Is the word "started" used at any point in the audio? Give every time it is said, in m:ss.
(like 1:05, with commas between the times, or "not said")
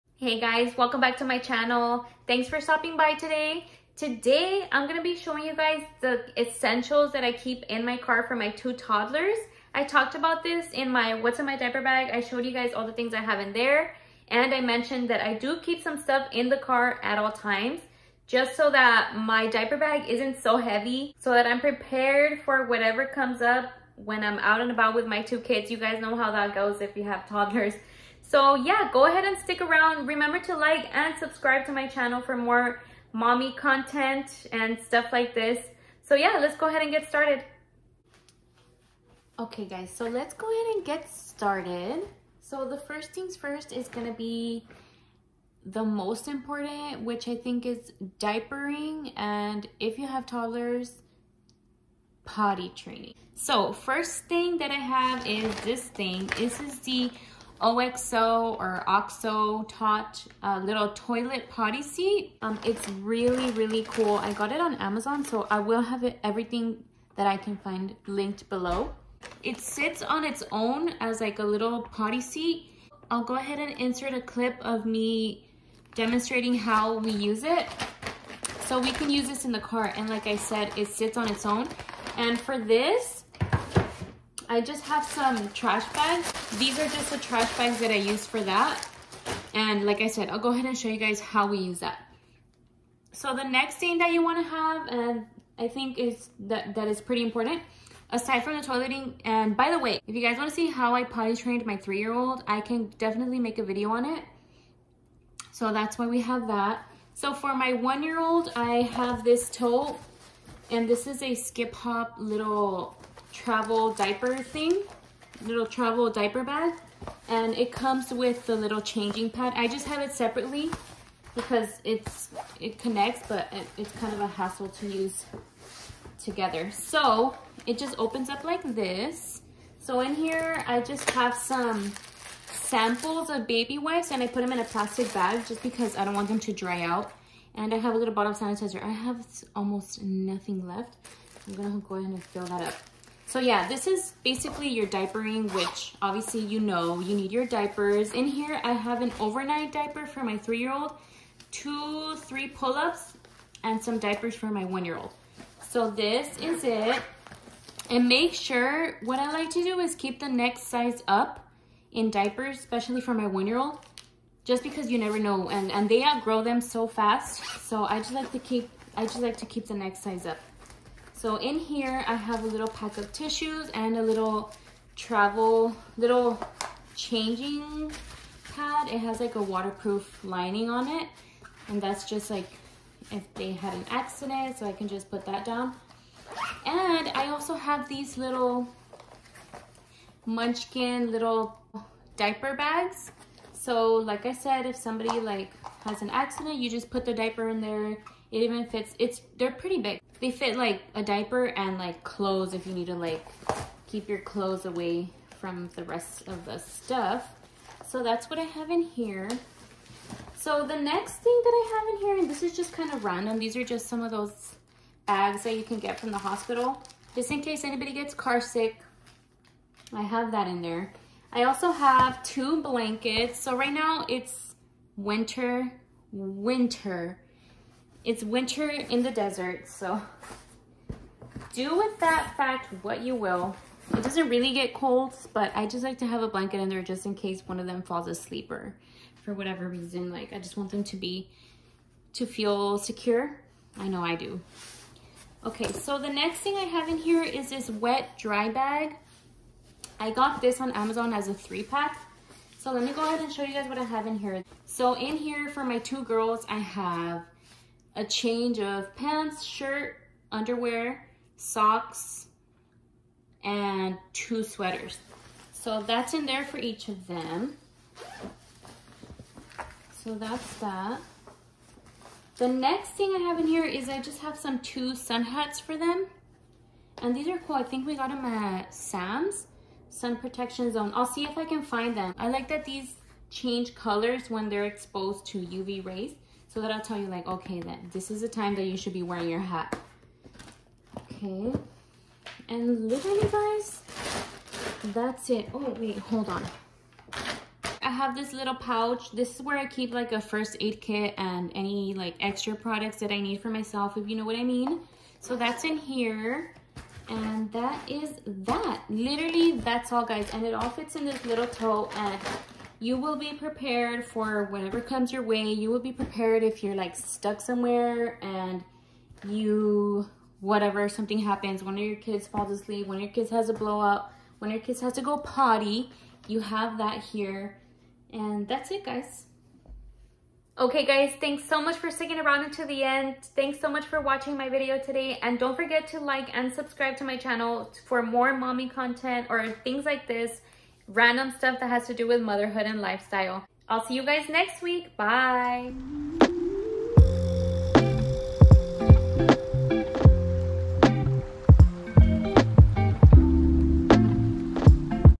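0:37, 0:41.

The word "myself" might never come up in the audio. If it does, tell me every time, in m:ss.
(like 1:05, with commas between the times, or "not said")
5:03.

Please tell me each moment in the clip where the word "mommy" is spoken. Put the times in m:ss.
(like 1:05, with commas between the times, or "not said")
0:33, 5:38.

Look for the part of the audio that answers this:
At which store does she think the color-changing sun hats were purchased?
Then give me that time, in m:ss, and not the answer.
4:38.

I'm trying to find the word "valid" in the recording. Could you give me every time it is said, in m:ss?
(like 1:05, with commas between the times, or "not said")
not said.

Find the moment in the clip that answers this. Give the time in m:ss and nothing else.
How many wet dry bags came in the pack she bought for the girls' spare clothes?
4:11.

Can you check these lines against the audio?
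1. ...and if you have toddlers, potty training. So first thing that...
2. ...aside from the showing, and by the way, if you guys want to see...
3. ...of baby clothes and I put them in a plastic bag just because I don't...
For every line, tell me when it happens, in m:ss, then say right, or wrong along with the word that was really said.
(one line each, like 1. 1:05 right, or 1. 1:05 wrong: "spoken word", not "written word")
1. 0:49 right
2. 1:38 wrong: "toileting", not "showing"
3. 2:13 wrong: "wipes", not "clothes".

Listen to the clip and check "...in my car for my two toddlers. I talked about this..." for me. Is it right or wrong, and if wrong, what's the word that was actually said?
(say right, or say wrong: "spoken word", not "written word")
right.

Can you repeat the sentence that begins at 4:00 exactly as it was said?
Like, I just want them to be, to feel secure.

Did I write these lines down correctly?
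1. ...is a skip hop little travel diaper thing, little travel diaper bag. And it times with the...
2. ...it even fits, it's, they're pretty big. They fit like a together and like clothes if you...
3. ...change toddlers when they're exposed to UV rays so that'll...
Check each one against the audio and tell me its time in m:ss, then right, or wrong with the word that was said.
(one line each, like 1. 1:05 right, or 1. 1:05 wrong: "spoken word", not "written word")
1. 1:51 wrong: "comes", not "times"
2. 3:18 wrong: "diaper", not "together"
3. 4:43 wrong: "colors", not "toddlers".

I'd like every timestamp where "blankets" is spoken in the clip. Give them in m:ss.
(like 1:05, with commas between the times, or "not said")
3:42, 3:56.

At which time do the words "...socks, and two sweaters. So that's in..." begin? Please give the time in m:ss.
4:21.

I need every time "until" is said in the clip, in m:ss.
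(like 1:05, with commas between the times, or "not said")
5:32.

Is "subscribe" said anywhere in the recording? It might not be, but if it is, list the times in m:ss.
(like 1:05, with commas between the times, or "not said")
0:31, 5:36.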